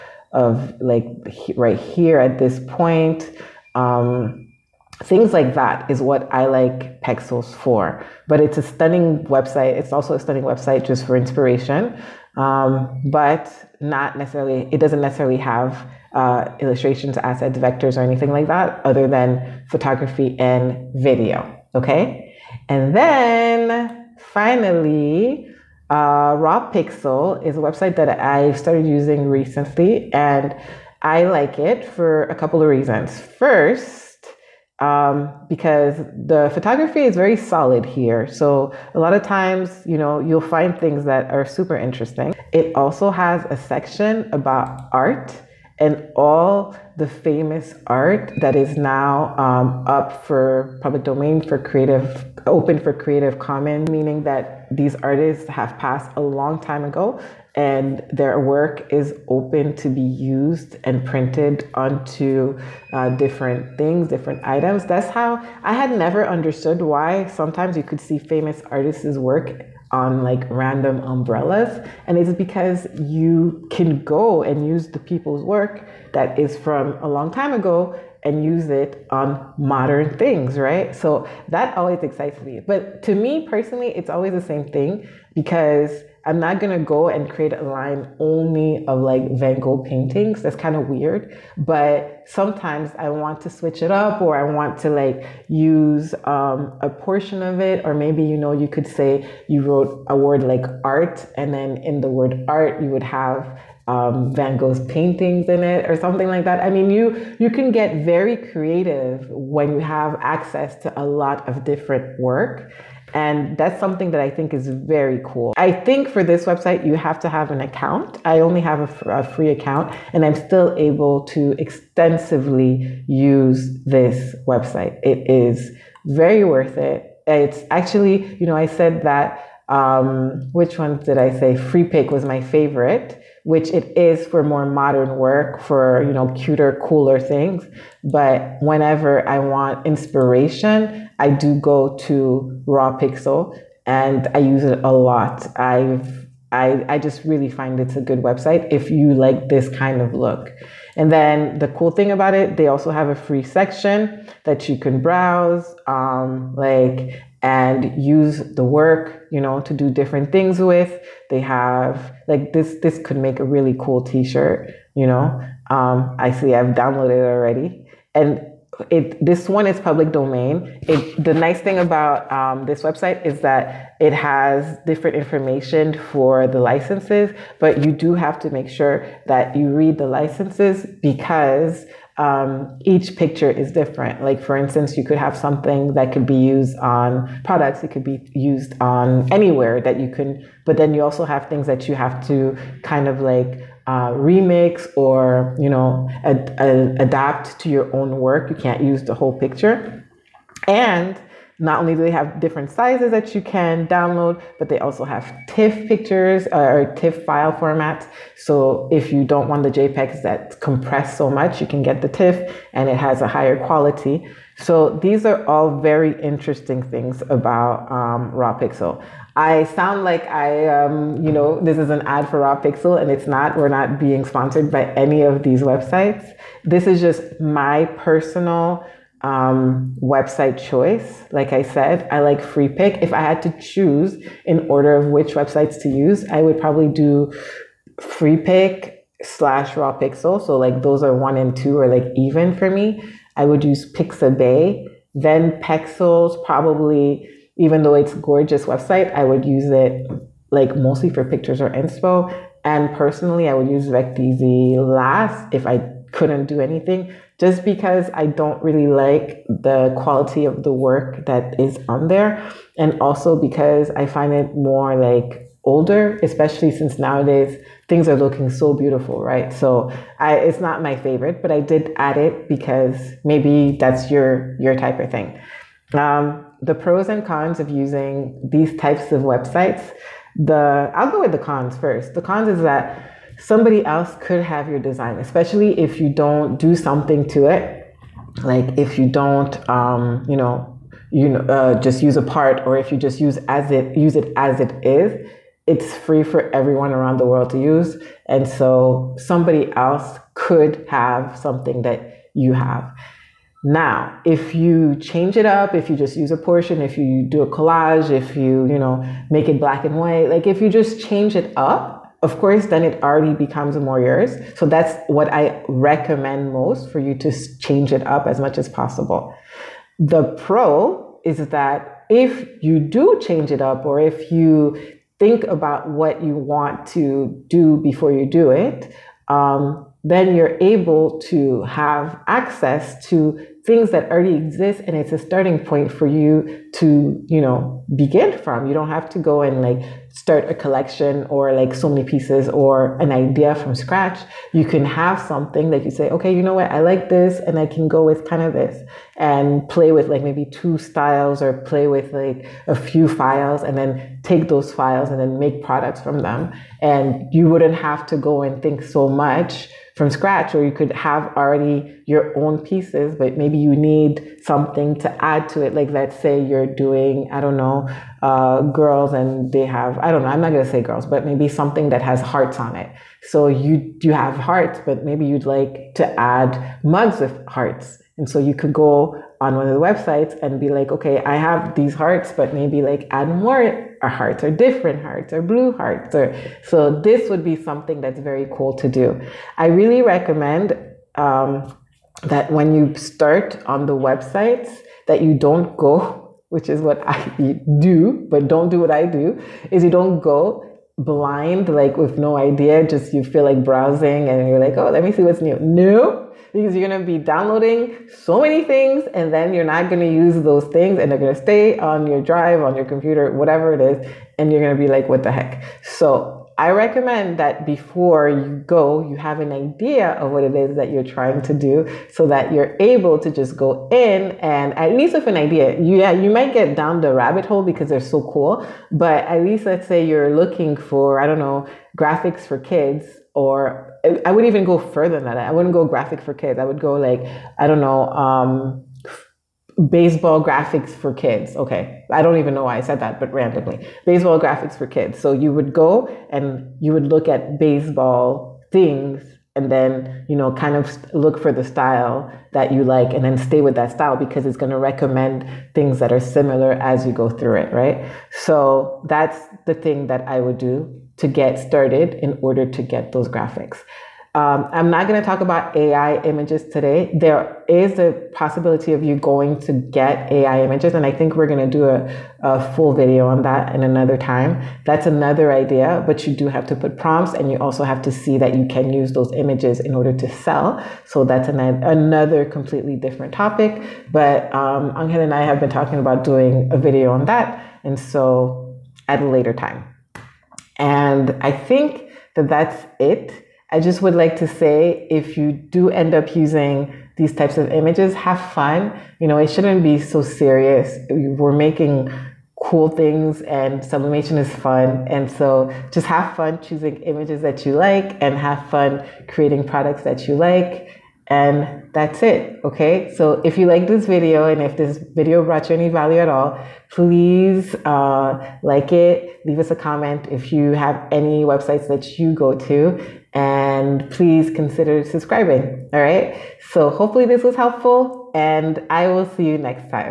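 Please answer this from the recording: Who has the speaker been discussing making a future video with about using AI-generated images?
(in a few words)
Angel.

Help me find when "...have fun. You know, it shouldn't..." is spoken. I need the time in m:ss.
8:18.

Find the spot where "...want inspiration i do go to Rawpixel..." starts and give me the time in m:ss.
2:19.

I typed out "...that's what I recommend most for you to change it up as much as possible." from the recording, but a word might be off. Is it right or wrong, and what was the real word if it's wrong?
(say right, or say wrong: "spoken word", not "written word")
right.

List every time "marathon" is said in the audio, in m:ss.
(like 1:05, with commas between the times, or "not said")
not said.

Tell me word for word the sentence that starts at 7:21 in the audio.
Okay, I don't even know why I said that, but randomly, baseball graphics for kids.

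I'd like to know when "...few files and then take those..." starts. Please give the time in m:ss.
5:52.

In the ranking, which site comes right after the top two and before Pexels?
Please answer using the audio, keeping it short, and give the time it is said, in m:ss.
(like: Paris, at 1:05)
Pixabay, at 4:03.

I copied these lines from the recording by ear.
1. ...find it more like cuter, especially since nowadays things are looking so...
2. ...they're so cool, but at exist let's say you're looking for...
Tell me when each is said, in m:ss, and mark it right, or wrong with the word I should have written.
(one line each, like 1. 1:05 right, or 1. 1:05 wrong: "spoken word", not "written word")
1. 4:24 wrong: "older", not "cuter"
2. 7:07 wrong: "least", not "exist".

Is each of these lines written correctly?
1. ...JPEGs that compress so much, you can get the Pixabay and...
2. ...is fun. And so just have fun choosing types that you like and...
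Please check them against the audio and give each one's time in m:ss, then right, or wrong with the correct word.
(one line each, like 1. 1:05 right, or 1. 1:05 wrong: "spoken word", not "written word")
1. 3:29 wrong: "TIFF", not "Pixabay"
2. 8:24 wrong: "images", not "types".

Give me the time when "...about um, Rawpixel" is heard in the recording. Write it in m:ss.
3:37.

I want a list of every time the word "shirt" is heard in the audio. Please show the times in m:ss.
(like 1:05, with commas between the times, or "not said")
2:44.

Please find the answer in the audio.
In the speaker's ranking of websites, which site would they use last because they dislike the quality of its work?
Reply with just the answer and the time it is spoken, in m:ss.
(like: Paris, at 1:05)
Vecteezy, at 4:13.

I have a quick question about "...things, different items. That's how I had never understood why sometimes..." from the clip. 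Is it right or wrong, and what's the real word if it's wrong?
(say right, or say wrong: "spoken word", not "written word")
right.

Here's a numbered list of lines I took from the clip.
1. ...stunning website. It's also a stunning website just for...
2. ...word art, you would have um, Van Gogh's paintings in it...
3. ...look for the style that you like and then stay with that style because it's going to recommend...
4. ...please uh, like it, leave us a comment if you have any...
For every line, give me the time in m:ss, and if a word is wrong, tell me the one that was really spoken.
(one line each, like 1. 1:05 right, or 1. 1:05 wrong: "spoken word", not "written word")
1. 0:08 right
2. 1:42 right
3. 7:31 right
4. 8:36 right.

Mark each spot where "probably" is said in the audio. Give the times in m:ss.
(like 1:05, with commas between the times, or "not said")
3:56, 4:06.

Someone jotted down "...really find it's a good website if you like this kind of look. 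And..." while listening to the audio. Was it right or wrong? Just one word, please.
right.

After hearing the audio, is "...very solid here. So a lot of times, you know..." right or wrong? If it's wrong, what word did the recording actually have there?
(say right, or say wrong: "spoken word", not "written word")
right.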